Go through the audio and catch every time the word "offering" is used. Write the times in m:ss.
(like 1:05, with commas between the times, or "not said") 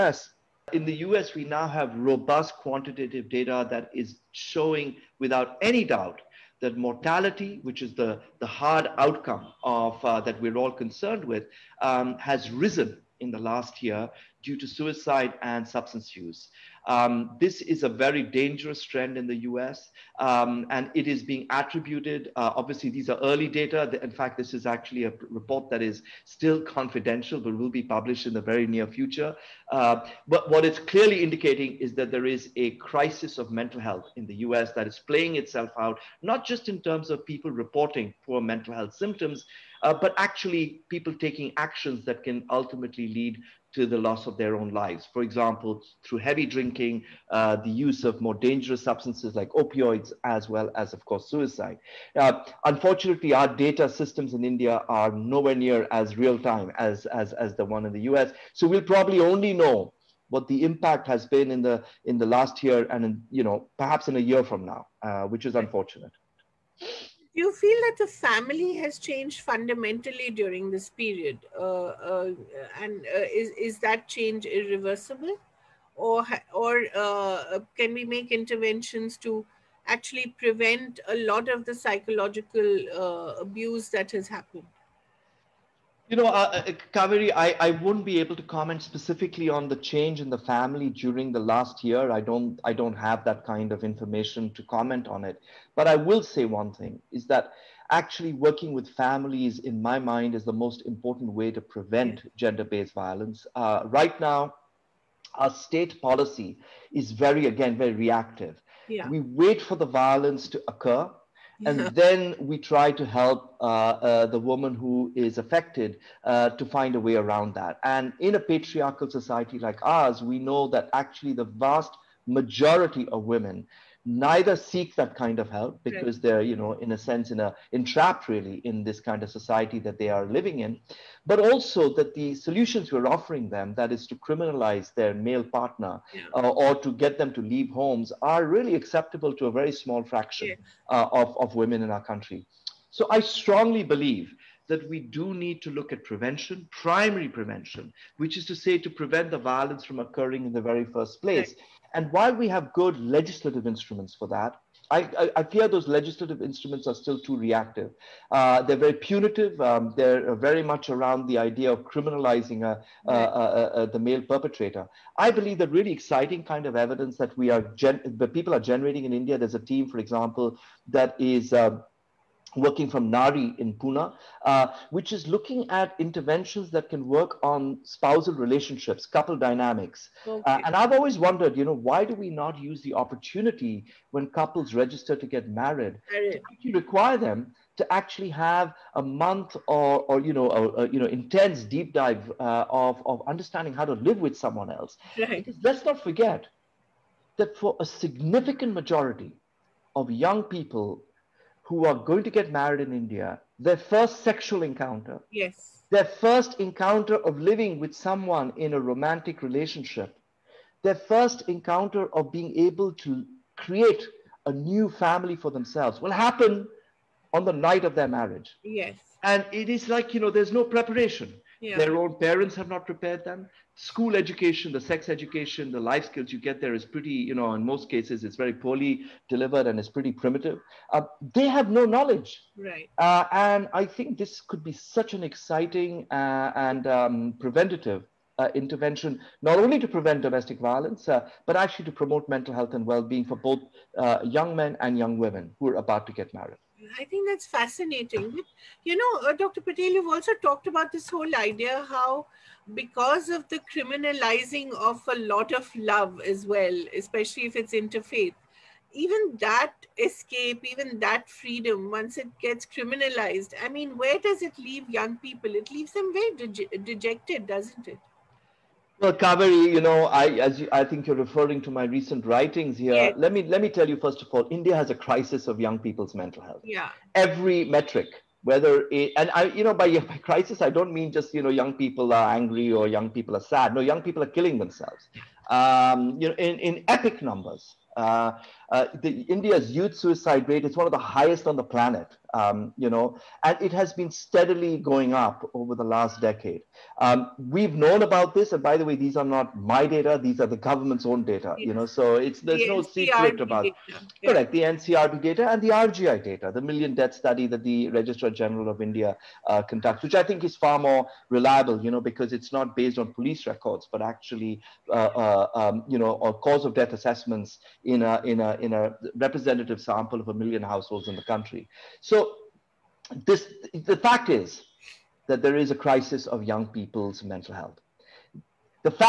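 2:13.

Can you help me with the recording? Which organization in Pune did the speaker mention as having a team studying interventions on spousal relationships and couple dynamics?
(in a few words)
Nari.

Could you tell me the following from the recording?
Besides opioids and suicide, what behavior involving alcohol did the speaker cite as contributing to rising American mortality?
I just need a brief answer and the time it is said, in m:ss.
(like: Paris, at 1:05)
heavy drinking, at 0:46.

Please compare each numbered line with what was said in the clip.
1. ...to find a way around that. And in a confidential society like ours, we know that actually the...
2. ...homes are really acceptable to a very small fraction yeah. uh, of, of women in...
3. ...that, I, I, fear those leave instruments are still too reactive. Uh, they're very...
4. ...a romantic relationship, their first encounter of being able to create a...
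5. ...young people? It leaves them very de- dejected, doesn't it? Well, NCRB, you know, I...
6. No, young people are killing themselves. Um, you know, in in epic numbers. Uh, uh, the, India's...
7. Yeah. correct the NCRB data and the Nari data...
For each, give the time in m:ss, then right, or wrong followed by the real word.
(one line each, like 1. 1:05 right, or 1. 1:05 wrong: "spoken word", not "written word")
1. 1:56 wrong: "patriarchal", not "confidential"
2. 2:17 right
3. 2:34 wrong: "legislative", not "leave"
4. 3:28 right
5. 4:24 wrong: "Kaveri", not "NCRB"
6. 4:43 right
7. 5:03 wrong: "RGI", not "Nari".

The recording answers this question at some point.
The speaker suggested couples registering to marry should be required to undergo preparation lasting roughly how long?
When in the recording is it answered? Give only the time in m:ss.
3:08.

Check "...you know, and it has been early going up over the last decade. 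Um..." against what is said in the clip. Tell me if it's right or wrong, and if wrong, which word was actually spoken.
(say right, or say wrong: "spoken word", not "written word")
wrong: "steadily", not "early".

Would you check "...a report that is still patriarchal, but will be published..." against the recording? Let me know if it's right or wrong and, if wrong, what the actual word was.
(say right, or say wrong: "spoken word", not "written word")
wrong: "confidential", not "patriarchal".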